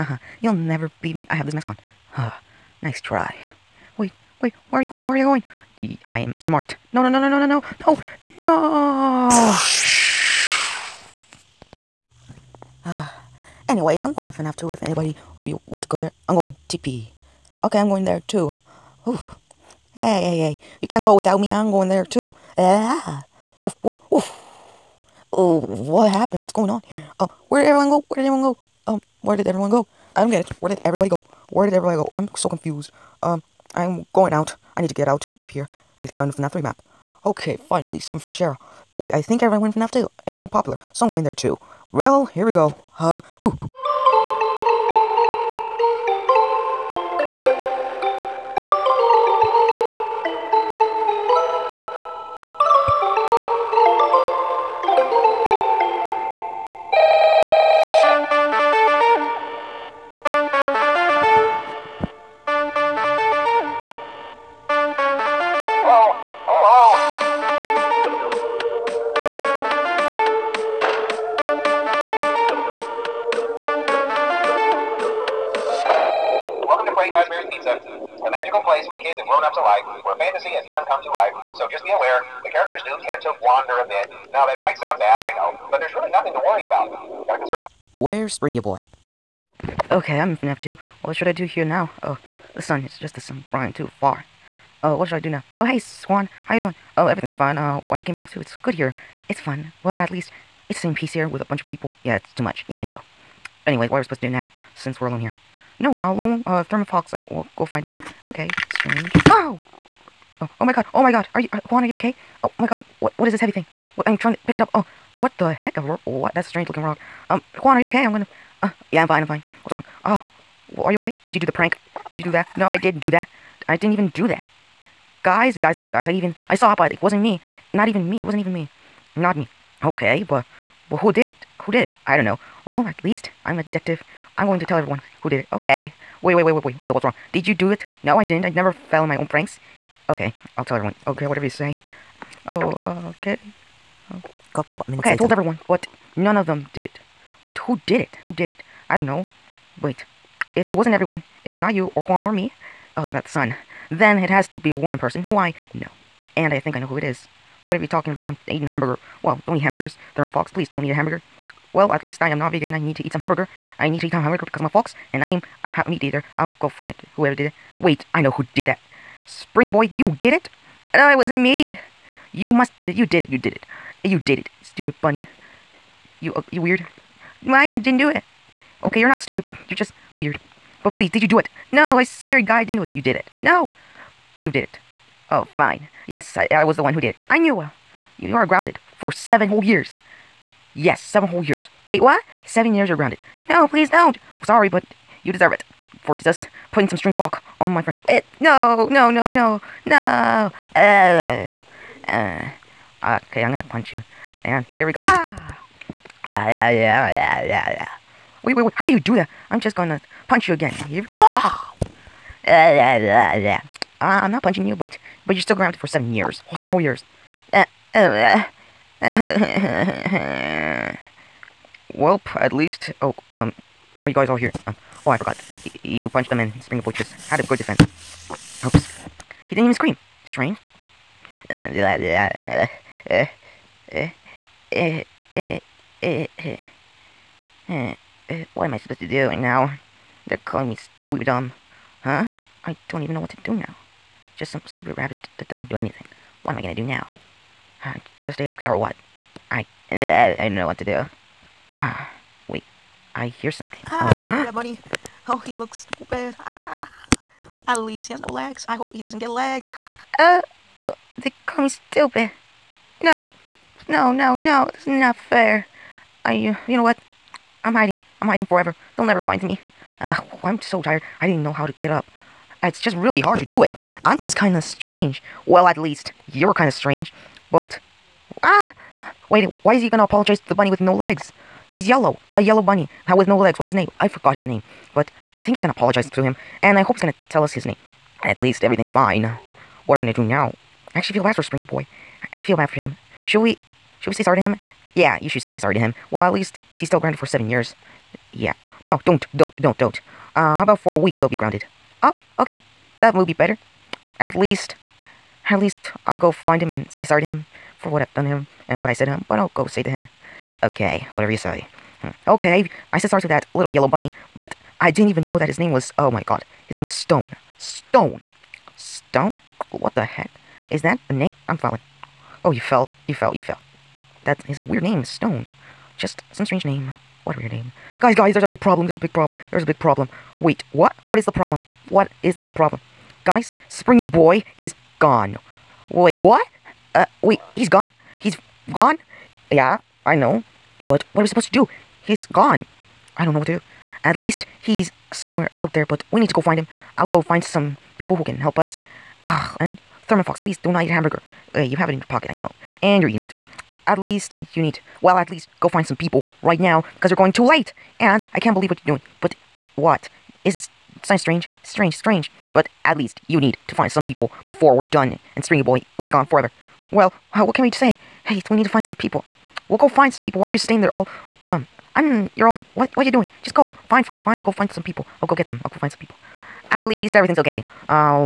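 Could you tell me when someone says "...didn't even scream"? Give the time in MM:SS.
03:49.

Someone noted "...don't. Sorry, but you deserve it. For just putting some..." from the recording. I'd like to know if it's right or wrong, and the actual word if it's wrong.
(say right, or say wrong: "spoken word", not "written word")
right.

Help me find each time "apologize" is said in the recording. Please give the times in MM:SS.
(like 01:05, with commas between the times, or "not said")
04:40, 04:45.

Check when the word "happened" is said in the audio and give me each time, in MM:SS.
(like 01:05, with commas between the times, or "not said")
00:26.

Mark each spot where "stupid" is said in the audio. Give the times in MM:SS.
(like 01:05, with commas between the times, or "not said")
02:54, 02:59, 04:04, 04:15, 04:21.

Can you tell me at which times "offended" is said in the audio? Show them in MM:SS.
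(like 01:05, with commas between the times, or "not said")
not said.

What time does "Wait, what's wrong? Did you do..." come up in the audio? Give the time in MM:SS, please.
02:16.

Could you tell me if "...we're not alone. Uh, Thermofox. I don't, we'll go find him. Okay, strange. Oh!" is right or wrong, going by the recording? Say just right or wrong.
right.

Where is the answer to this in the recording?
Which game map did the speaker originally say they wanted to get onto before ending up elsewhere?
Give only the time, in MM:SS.
00:36.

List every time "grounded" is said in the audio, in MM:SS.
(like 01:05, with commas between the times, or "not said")
03:08, 03:12, 03:35, 04:56, 05:01.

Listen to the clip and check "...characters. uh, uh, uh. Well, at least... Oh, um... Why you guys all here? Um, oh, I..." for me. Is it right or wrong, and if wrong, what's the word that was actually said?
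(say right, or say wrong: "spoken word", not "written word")
wrong: "years", not "characters".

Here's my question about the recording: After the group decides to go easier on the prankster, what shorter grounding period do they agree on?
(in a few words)
A week.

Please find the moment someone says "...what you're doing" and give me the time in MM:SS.
05:58.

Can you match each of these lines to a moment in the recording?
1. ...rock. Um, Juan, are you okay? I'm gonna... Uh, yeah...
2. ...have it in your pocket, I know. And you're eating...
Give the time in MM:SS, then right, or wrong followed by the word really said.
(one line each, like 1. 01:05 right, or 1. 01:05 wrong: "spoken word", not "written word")
1. 01:56 right
2. 05:51 right.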